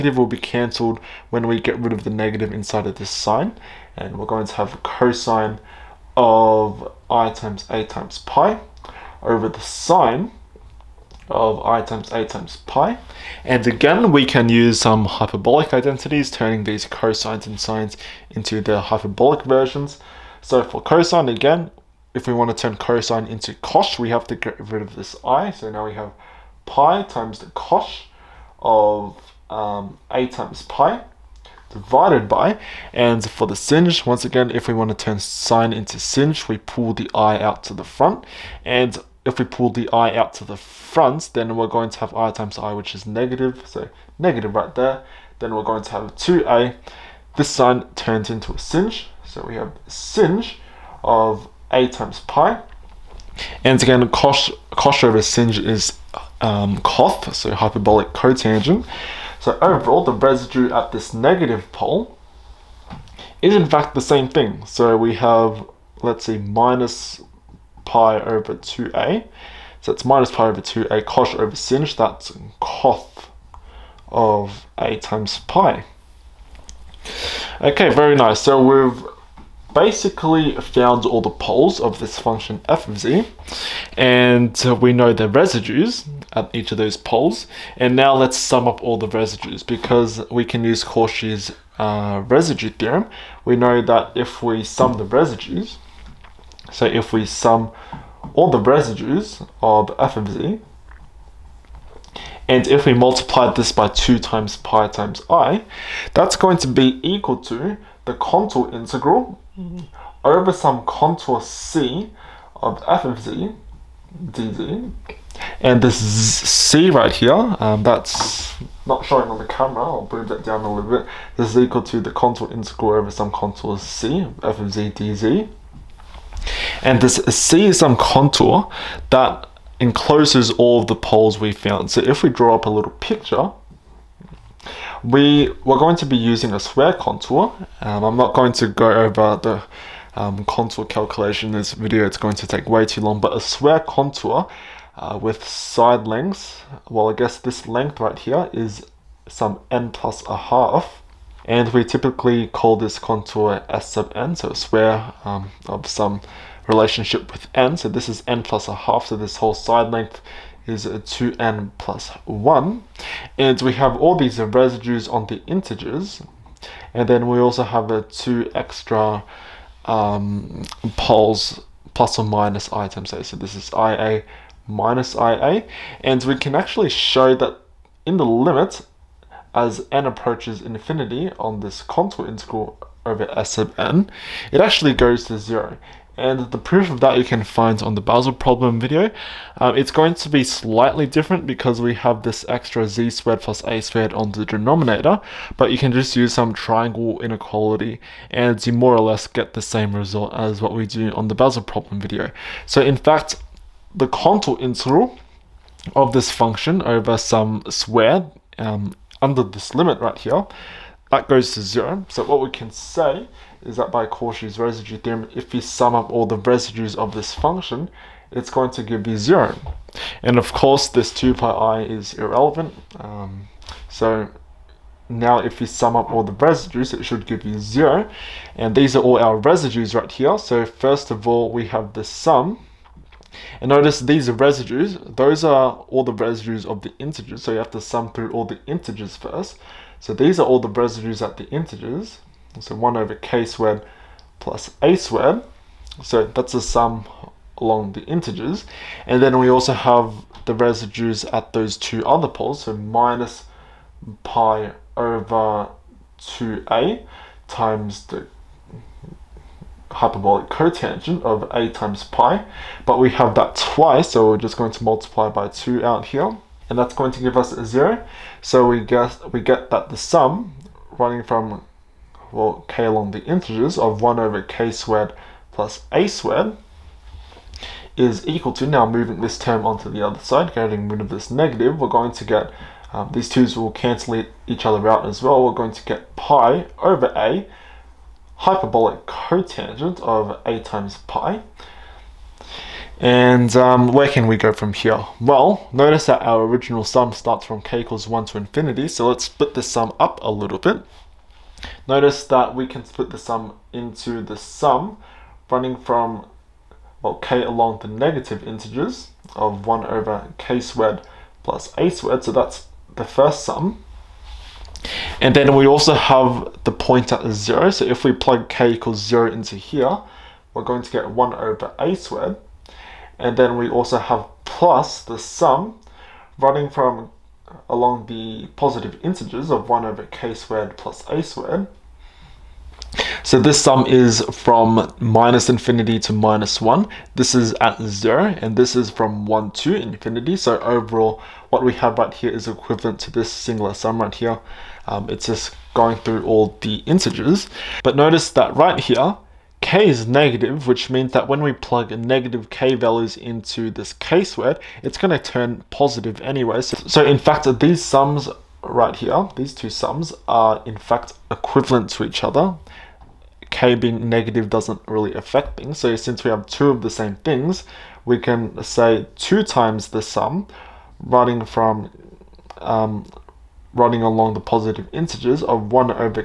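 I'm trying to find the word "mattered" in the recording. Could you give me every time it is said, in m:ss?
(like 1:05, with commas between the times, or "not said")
not said.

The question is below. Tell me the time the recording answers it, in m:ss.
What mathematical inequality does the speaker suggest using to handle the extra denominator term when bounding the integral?
3:16.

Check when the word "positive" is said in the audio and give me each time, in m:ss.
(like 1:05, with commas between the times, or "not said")
5:28, 5:55, 6:14.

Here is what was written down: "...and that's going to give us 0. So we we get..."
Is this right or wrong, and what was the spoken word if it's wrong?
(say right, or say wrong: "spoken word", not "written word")
right.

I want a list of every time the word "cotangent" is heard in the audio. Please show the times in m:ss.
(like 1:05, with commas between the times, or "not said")
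0:58, 4:20, 4:49.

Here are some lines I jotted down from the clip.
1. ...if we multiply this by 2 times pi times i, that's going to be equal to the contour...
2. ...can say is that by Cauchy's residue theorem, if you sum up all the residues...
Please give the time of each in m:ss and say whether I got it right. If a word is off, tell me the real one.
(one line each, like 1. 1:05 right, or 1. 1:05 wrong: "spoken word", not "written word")
1. 1:42 right
2. 3:32 right.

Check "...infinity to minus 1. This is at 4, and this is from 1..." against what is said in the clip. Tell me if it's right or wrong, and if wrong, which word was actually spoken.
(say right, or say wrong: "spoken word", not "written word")
wrong: "0", not "4".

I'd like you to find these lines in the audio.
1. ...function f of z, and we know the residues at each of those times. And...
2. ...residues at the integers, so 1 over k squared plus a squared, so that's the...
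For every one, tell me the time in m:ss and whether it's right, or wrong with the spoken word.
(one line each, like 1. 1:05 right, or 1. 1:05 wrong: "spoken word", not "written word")
1. 1:22 wrong: "poles", not "times"
2. 4:00 right.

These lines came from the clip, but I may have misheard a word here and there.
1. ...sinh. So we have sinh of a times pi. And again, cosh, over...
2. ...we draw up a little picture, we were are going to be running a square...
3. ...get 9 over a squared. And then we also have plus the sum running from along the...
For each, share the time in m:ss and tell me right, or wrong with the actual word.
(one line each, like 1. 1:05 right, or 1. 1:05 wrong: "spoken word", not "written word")
1. 0:48 right
2. 2:12 wrong: "using", not "running"
3. 5:20 wrong: "1", not "9".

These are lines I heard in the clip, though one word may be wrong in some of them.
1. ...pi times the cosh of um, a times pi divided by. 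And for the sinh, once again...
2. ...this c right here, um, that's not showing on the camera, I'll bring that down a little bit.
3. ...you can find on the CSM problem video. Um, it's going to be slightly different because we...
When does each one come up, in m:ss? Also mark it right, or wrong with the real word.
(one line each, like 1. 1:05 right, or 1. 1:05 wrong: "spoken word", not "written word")
1. 0:26 right
2. 1:55 right
3. 3:07 wrong: "Basel", not "CSM".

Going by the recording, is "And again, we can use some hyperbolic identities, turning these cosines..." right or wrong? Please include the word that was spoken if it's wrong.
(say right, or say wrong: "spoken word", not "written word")
right.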